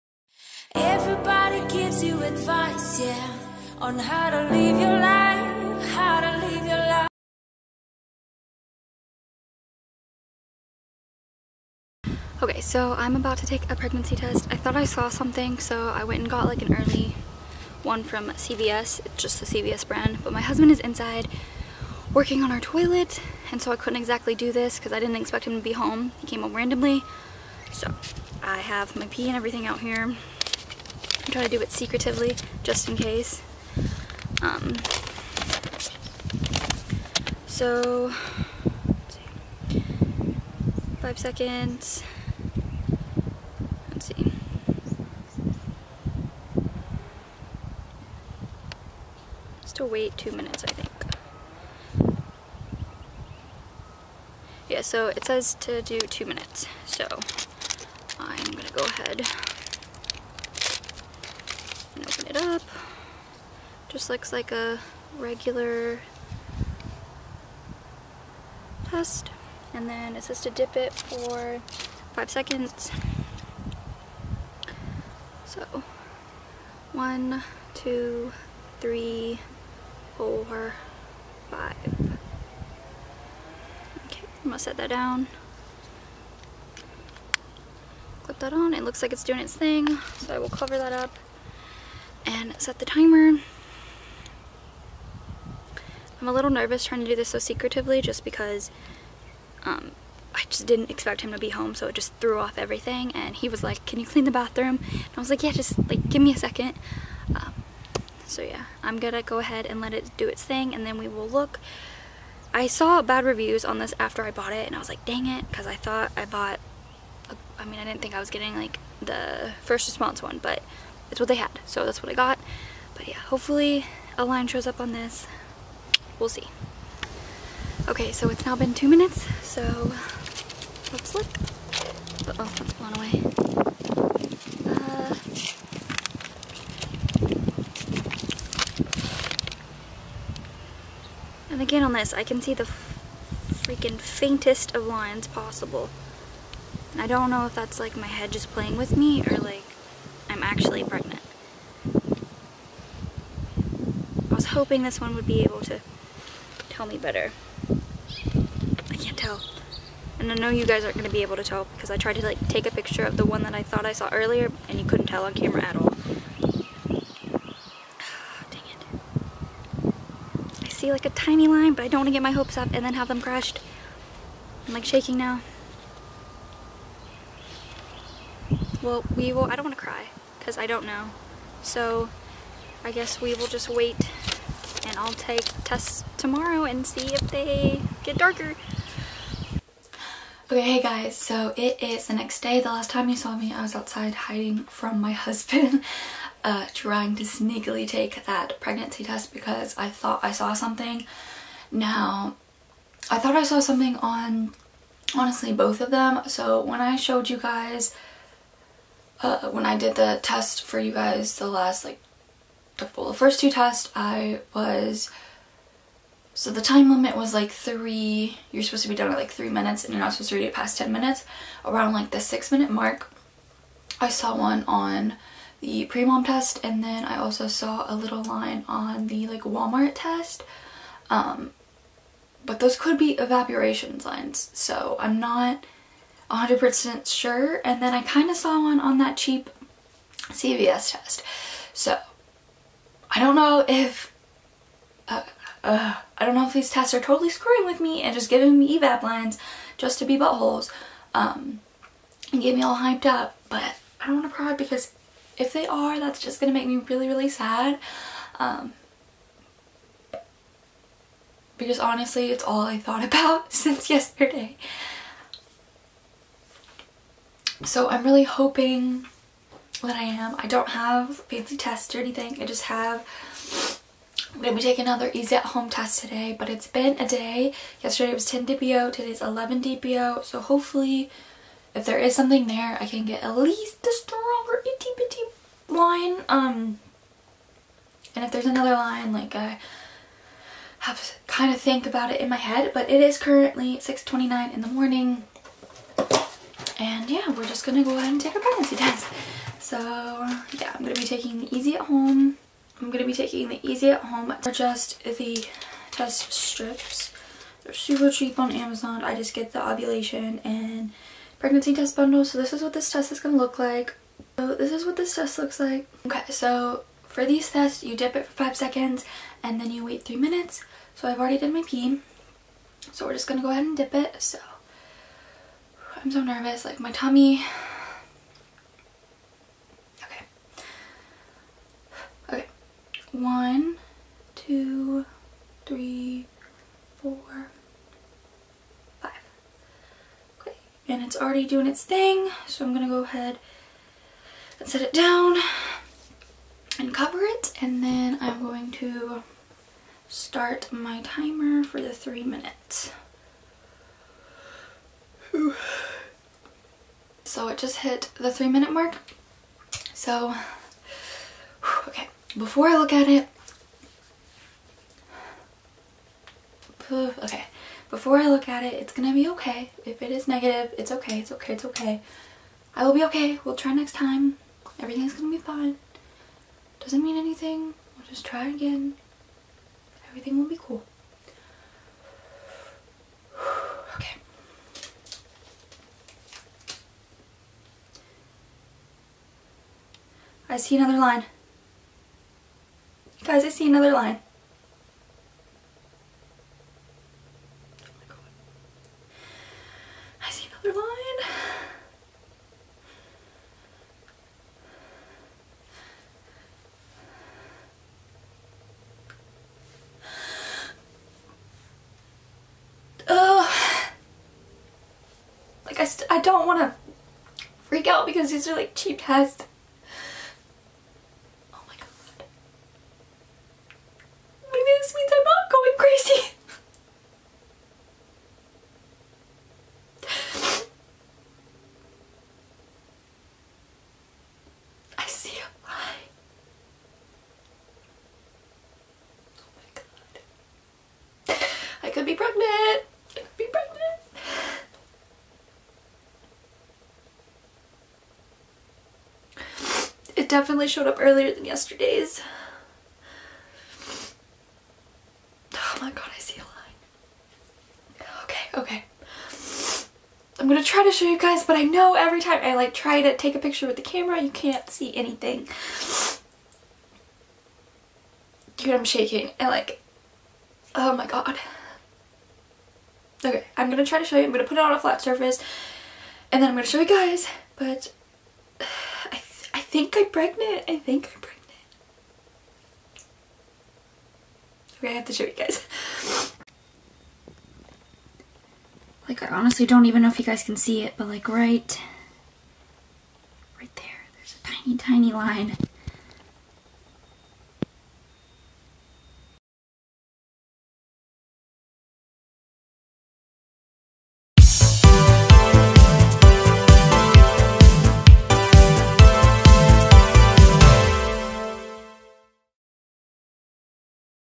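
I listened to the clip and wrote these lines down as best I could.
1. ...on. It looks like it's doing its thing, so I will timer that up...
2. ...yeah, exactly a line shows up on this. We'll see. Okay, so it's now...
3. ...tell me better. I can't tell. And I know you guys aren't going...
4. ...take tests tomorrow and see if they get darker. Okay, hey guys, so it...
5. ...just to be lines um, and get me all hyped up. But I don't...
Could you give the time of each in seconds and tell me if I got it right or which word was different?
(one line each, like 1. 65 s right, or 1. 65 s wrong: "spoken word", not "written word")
1. 88 s wrong: "cover", not "timer"
2. 123 s wrong: "hopefully", not "exactly"
3. 156 s right
4. 185 s right
5. 249 s wrong: "buttholes", not "lines".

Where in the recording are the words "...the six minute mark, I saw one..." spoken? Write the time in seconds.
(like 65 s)
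222 s.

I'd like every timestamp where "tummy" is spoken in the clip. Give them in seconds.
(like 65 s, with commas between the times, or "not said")
326 s.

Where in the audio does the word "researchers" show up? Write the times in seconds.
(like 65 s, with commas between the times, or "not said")
not said.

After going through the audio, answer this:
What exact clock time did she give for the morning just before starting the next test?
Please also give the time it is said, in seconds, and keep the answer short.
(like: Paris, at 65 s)
6:29, at 293 s.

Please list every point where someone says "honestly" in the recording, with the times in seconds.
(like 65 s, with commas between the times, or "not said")
205 s, 261 s, 489 s.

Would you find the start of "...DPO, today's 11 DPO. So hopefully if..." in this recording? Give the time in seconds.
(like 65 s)
278 s.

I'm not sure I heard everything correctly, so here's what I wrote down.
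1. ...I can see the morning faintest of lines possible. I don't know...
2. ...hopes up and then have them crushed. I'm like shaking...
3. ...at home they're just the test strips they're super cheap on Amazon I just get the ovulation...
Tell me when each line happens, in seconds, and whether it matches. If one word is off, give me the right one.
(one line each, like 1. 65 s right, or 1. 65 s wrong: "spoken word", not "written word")
1. 142 s wrong: "freaking", not "morning"
2. 172 s right
3. 303 s right.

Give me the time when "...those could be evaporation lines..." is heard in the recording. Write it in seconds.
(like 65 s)
232 s.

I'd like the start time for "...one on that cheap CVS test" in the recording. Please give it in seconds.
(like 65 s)
238 s.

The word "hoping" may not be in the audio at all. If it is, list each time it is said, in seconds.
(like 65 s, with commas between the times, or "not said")
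154 s, 268 s.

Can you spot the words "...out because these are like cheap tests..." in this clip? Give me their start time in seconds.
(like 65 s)
417 s.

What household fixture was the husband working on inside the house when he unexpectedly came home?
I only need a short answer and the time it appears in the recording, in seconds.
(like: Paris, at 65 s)
Toilet, at 22 s.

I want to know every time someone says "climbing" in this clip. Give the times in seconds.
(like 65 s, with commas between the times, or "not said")
not said.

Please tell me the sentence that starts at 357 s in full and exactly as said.
it just hit the three minute mark.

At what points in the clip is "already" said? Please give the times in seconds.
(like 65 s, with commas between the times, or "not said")
321 s, 341 s.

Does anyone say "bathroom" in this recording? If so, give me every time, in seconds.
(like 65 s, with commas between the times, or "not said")
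104 s.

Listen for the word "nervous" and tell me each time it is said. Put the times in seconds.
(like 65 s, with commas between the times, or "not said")
96 s, 326 s.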